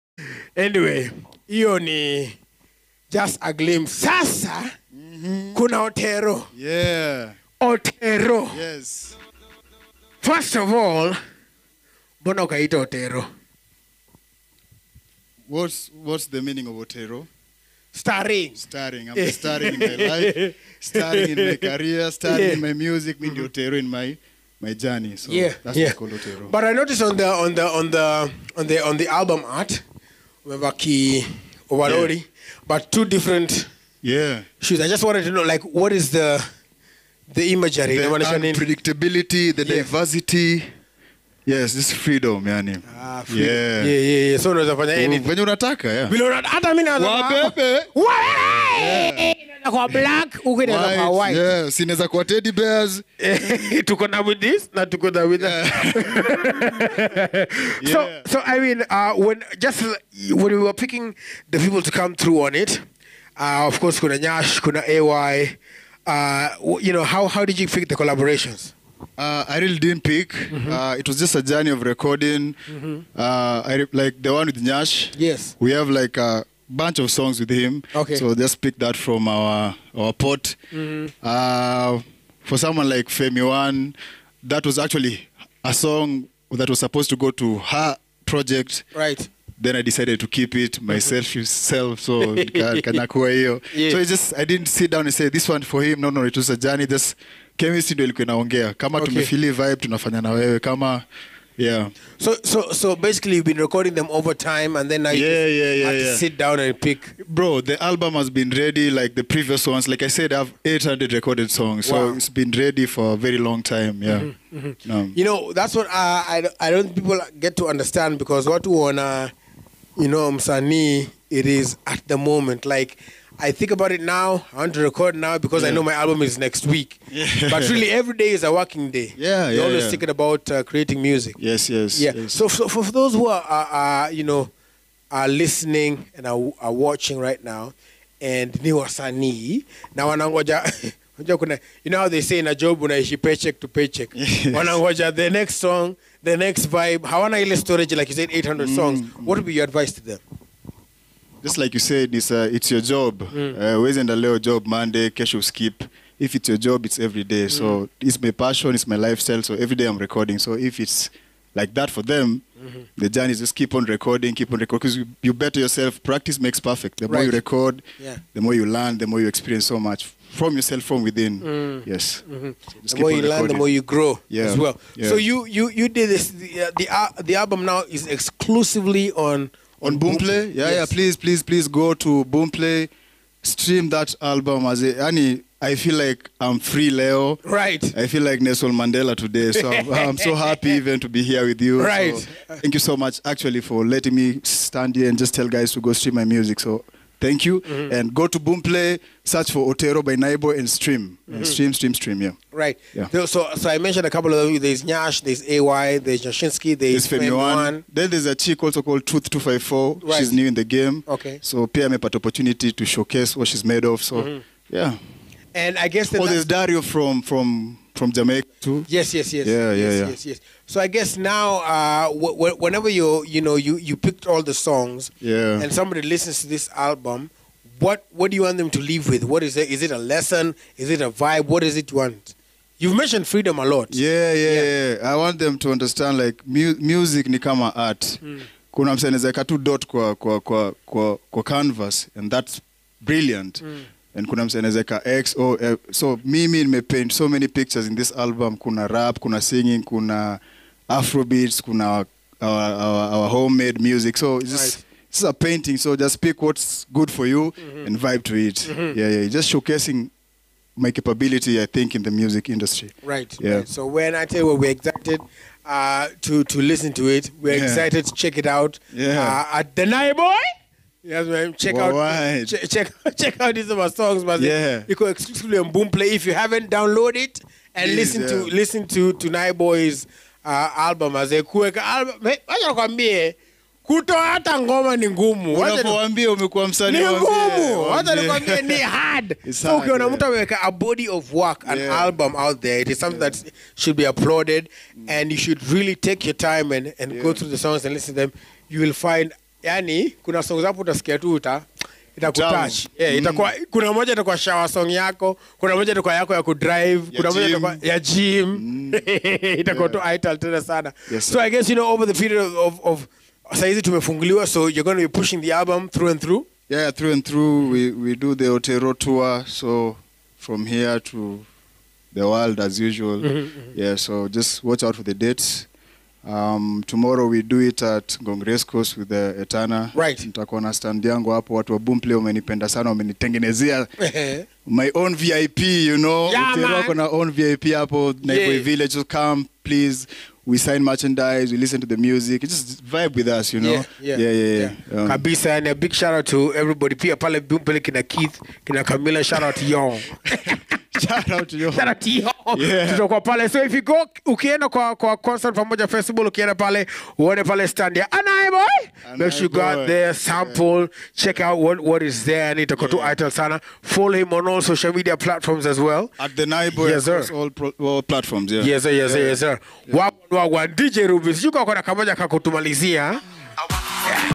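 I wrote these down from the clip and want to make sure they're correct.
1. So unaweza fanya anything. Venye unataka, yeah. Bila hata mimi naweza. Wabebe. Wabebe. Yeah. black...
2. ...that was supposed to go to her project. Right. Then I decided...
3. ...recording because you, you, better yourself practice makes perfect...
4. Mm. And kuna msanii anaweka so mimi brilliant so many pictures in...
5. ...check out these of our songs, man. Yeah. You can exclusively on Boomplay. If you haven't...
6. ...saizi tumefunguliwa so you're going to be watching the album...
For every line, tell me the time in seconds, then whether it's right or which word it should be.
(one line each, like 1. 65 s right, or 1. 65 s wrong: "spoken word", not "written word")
1. 44 s right
2. 86 s right
3. 164 s right
4. 243 s wrong: "paint", not "brilliant"
5. 273 s right
6. 313 s wrong: "pushing", not "watching".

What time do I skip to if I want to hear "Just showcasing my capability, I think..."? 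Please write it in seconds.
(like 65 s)
259 s.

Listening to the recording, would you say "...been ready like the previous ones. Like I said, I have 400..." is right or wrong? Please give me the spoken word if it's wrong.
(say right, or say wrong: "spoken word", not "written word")
wrong: "800", not "400".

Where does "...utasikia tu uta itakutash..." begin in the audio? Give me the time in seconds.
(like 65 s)
300 s.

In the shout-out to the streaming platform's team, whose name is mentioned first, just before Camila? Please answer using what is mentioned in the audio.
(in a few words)
Keith.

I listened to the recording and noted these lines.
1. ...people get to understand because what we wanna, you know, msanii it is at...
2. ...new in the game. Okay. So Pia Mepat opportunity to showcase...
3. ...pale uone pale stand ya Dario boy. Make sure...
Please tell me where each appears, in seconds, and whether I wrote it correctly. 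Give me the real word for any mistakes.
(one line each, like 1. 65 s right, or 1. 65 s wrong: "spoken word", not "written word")
1. 116 s right
2. 210 s right
3. 356 s wrong: "Anaye", not "Dario".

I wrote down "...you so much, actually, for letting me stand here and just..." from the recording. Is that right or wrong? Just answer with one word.
right.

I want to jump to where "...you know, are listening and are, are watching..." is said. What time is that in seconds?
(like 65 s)
134 s.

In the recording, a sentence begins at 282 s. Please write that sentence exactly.
Hey, acha nikwambie kutoa hata ngoma ni ngumu.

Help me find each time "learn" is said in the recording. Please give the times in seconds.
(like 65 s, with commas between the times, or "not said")
168 s, 173 s.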